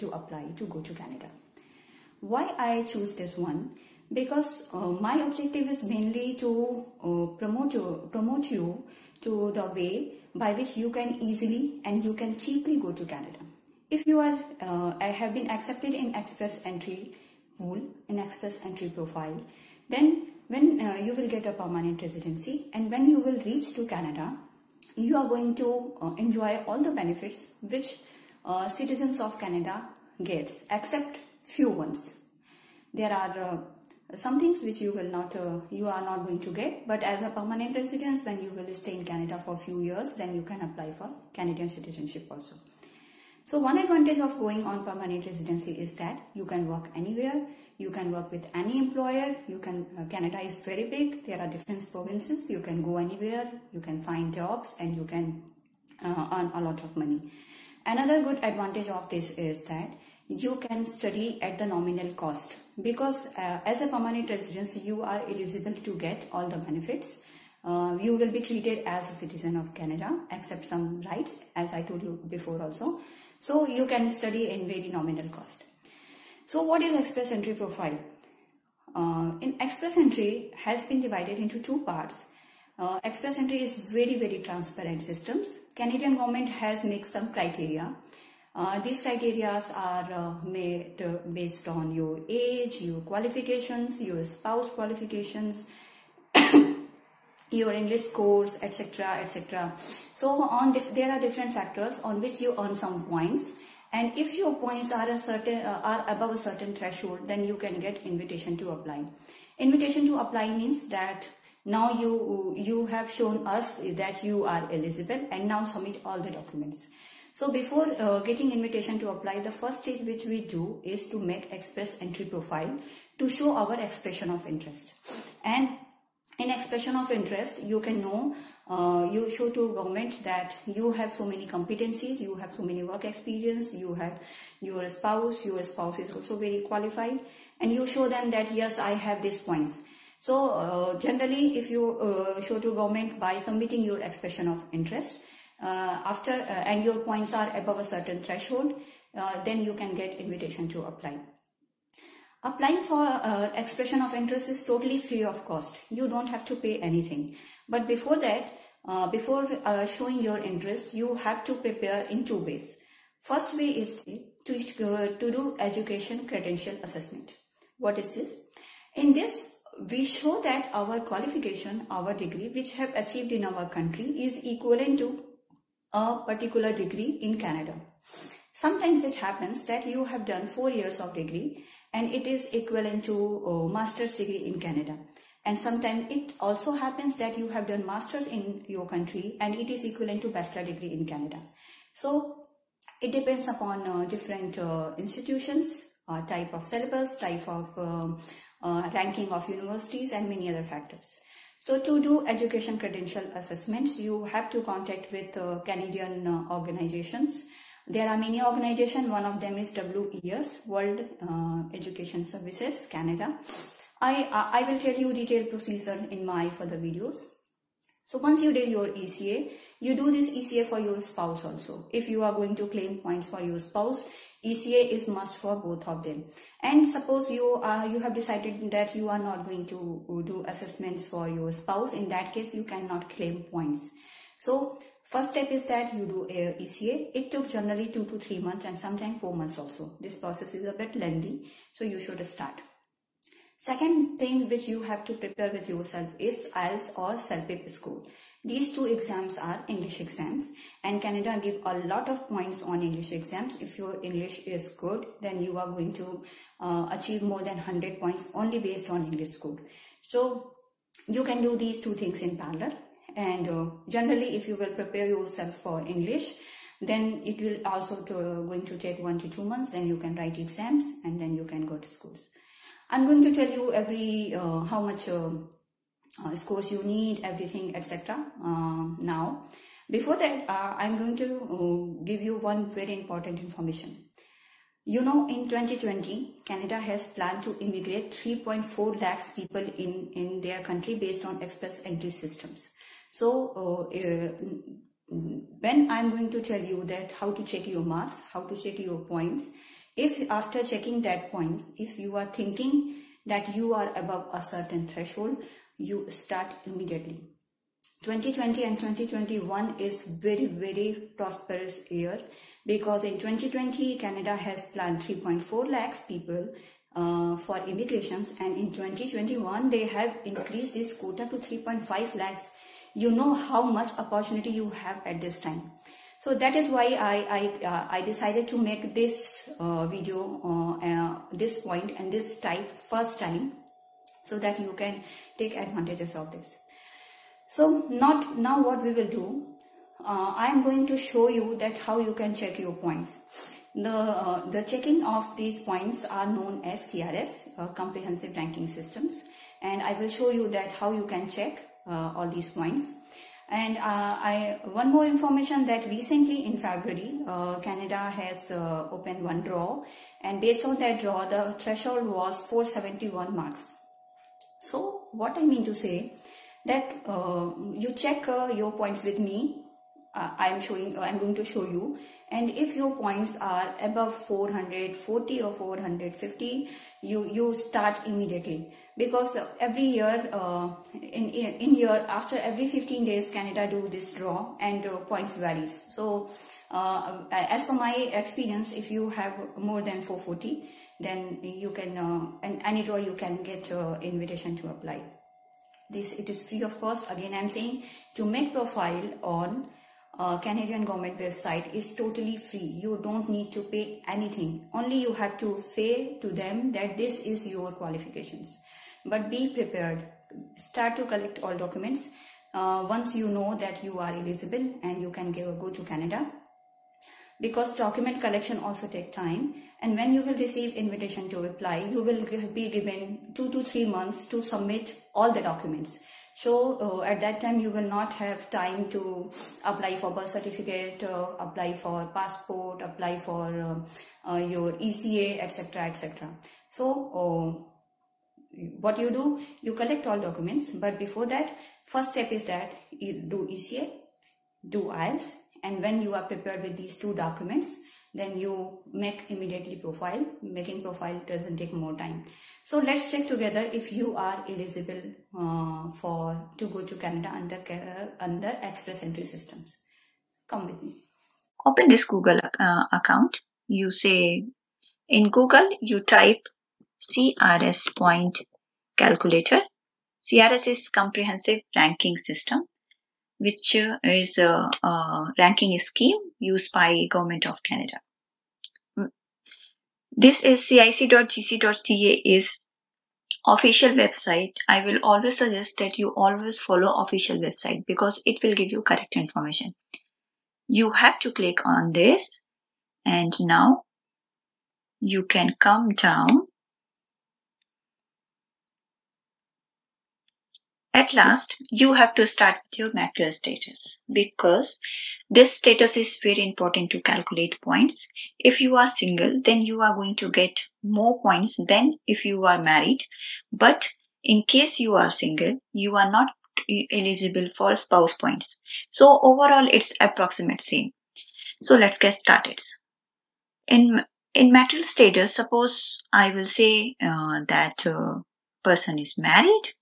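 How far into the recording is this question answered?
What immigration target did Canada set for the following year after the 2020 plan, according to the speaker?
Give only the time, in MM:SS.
05:21.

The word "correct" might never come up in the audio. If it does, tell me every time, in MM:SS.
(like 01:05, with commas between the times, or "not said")
08:08.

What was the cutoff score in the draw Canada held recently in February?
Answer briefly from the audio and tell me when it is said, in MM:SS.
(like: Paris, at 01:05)
471, at 06:02.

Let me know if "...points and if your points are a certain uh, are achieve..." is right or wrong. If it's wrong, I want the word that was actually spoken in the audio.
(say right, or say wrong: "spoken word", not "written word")
wrong: "above", not "achieve".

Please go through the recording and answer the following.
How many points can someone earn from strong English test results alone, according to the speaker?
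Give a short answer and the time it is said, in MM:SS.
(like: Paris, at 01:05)
more than 100, at 04:17.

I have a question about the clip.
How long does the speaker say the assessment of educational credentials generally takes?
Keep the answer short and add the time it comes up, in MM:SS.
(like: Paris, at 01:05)
2 to 3 months, at 03:57.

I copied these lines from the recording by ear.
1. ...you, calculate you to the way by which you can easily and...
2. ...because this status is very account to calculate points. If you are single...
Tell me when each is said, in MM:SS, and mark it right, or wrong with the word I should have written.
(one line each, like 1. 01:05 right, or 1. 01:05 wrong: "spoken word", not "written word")
1. 00:07 wrong: "promote", not "calculate"
2. 08:24 wrong: "important", not "account".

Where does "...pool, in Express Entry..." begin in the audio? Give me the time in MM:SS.
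00:17.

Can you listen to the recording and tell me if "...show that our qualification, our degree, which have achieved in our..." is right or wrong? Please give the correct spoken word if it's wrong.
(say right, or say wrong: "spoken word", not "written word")
right.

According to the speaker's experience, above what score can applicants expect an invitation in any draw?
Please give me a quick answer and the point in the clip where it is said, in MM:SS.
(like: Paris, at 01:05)
440, at 06:29.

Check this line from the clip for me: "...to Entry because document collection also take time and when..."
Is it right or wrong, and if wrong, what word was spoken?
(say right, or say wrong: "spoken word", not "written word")
wrong: "Canada", not "Entry".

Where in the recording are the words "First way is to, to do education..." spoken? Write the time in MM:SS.
02:43.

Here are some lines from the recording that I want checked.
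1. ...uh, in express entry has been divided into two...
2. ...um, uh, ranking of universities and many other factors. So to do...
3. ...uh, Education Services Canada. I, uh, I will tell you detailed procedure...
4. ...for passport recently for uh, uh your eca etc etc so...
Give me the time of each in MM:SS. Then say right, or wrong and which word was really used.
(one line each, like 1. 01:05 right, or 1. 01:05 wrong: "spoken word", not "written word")
1. 01:18 right
2. 03:17 right
3. 03:31 right
4. 07:11 wrong: "apply", not "recently".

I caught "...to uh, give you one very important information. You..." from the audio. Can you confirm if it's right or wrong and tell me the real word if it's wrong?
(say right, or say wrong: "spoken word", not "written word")
right.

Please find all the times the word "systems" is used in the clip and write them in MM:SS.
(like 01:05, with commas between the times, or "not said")
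01:25, 04:52, 05:48, 07:39, 07:52.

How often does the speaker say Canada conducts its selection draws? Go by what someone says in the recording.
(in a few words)
every 15 days.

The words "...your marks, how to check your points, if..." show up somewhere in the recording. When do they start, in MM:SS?
04:57.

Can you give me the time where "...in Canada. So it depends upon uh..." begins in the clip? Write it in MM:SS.
03:10.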